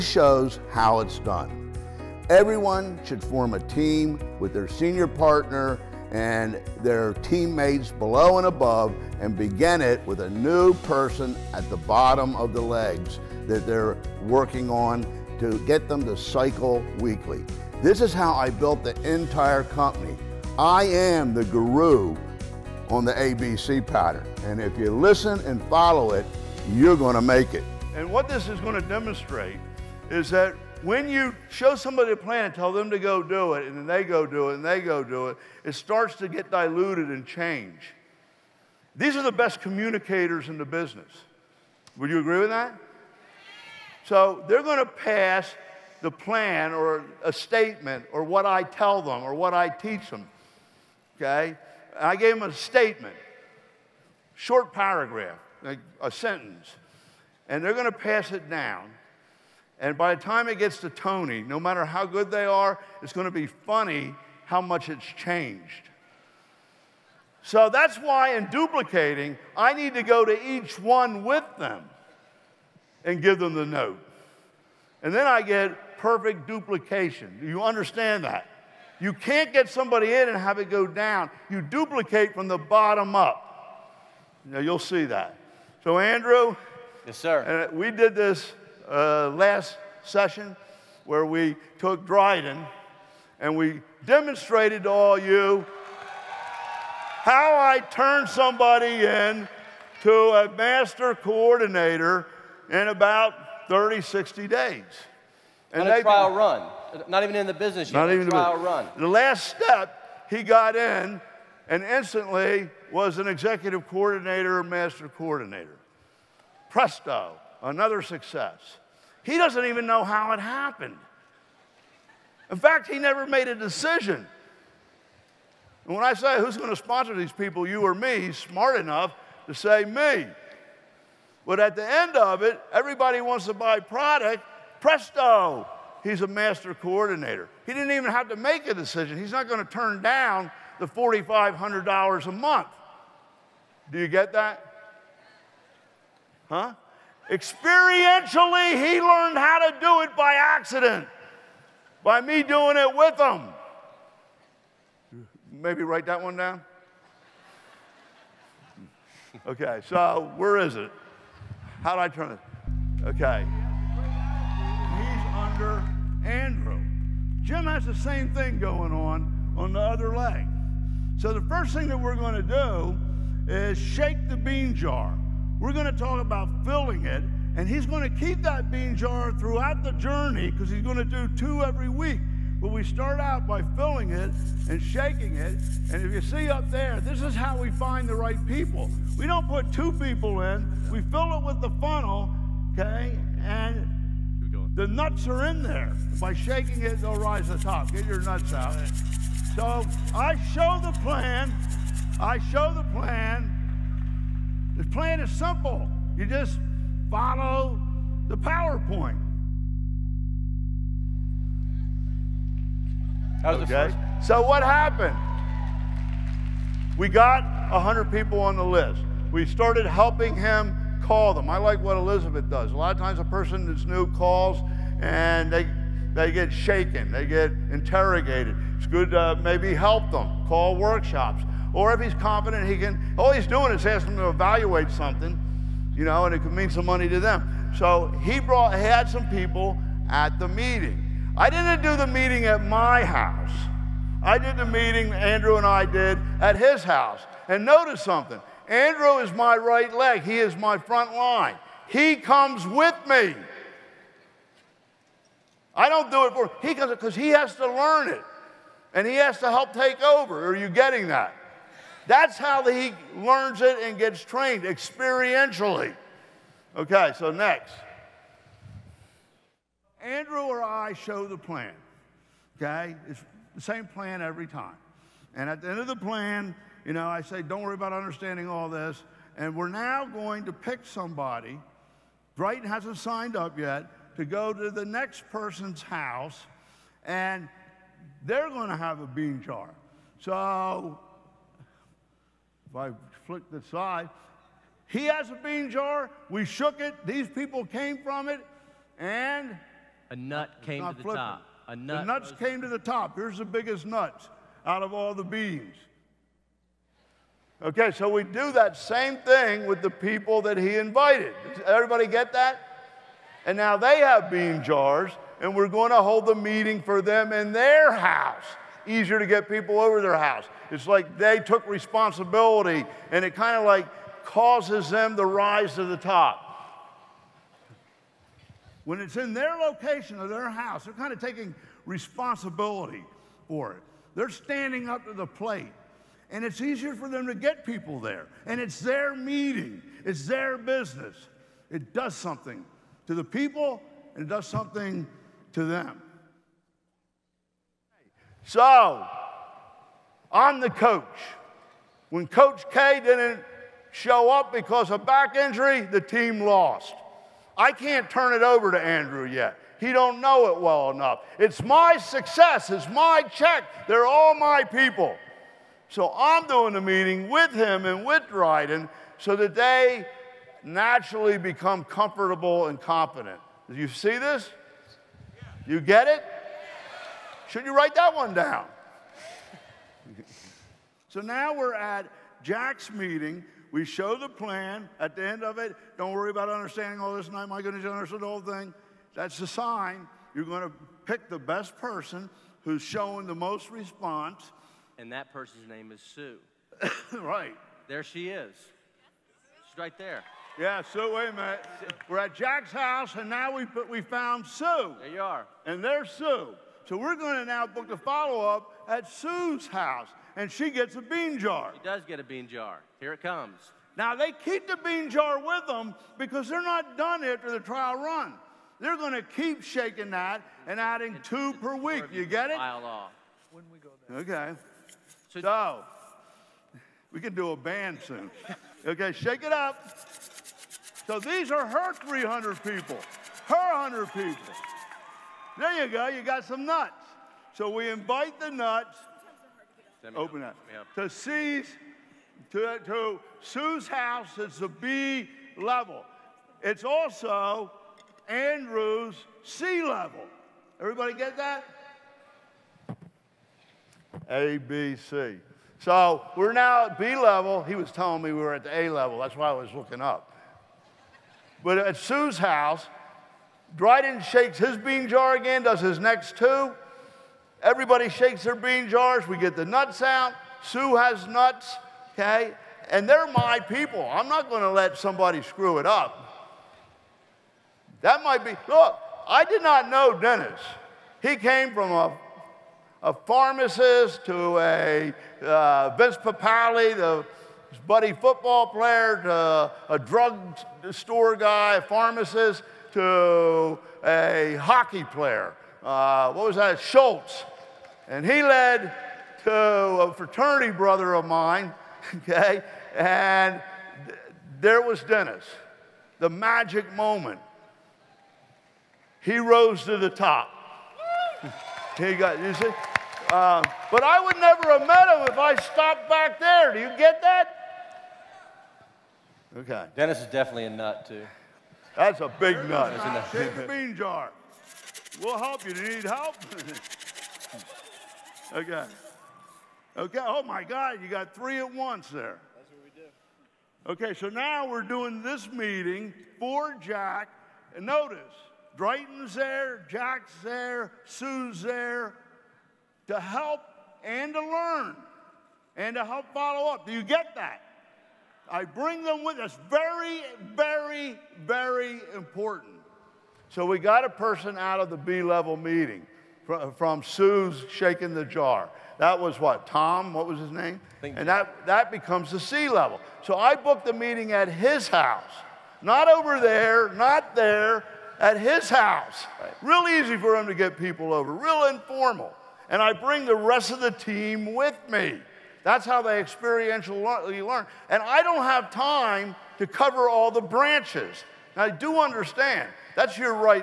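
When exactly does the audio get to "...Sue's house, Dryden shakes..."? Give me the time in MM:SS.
07:41.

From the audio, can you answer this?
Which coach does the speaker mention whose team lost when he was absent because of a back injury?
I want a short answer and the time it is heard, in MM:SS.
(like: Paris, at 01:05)
Coach K, at 05:52.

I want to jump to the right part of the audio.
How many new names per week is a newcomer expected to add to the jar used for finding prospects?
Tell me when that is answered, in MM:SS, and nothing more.
03:01.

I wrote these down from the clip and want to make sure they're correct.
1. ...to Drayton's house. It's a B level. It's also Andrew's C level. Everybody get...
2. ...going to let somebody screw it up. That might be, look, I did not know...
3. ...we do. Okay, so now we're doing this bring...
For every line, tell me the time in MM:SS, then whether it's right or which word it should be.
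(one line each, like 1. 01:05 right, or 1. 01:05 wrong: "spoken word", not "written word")
1. 07:22 wrong: "Sue", not "Drayton"
2. 07:54 right
3. 08:53 wrong: "meeting", not "bring".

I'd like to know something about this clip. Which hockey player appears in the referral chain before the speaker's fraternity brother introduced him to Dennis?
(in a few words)
Schultz.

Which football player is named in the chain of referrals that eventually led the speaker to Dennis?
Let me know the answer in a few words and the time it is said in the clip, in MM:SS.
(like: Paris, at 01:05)
Vince Papale, at 08:05.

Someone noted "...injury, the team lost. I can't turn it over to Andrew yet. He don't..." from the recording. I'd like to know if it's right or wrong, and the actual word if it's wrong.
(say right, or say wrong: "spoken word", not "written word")
right.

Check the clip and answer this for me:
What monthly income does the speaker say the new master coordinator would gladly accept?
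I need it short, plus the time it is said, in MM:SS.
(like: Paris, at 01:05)
$4,500, at 02:20.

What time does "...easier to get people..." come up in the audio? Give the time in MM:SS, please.
05:18.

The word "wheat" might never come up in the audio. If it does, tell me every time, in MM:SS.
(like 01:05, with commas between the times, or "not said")
not said.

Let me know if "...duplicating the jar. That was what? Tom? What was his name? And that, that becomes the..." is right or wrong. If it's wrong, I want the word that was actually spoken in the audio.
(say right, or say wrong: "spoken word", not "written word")
wrong: "shaking", not "duplicating".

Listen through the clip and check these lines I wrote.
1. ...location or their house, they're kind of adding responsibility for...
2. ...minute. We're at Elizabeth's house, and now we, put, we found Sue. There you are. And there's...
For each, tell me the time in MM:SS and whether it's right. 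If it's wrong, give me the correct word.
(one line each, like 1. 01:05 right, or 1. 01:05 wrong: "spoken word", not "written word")
1. 05:29 wrong: "taking", not "adding"
2. 06:41 wrong: "Jack", not "Elizabeth".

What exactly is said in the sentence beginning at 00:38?
These are the best communicators in the business.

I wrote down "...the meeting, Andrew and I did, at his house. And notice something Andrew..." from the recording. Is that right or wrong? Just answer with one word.
right.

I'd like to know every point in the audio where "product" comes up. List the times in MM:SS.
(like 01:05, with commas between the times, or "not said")
02:13.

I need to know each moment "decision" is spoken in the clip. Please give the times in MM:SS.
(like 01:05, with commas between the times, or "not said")
02:03, 02:18.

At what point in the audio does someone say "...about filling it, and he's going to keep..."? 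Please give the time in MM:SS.
02:56.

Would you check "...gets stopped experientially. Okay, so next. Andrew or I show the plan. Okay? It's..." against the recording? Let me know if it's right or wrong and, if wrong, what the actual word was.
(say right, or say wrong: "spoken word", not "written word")
wrong: "trained", not "stopped".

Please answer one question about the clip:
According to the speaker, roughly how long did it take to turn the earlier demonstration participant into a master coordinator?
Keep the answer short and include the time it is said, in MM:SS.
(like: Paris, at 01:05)
30, 60 days, at 01:43.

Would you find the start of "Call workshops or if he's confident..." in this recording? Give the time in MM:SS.
03:50.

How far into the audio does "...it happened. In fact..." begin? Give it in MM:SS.
02:00.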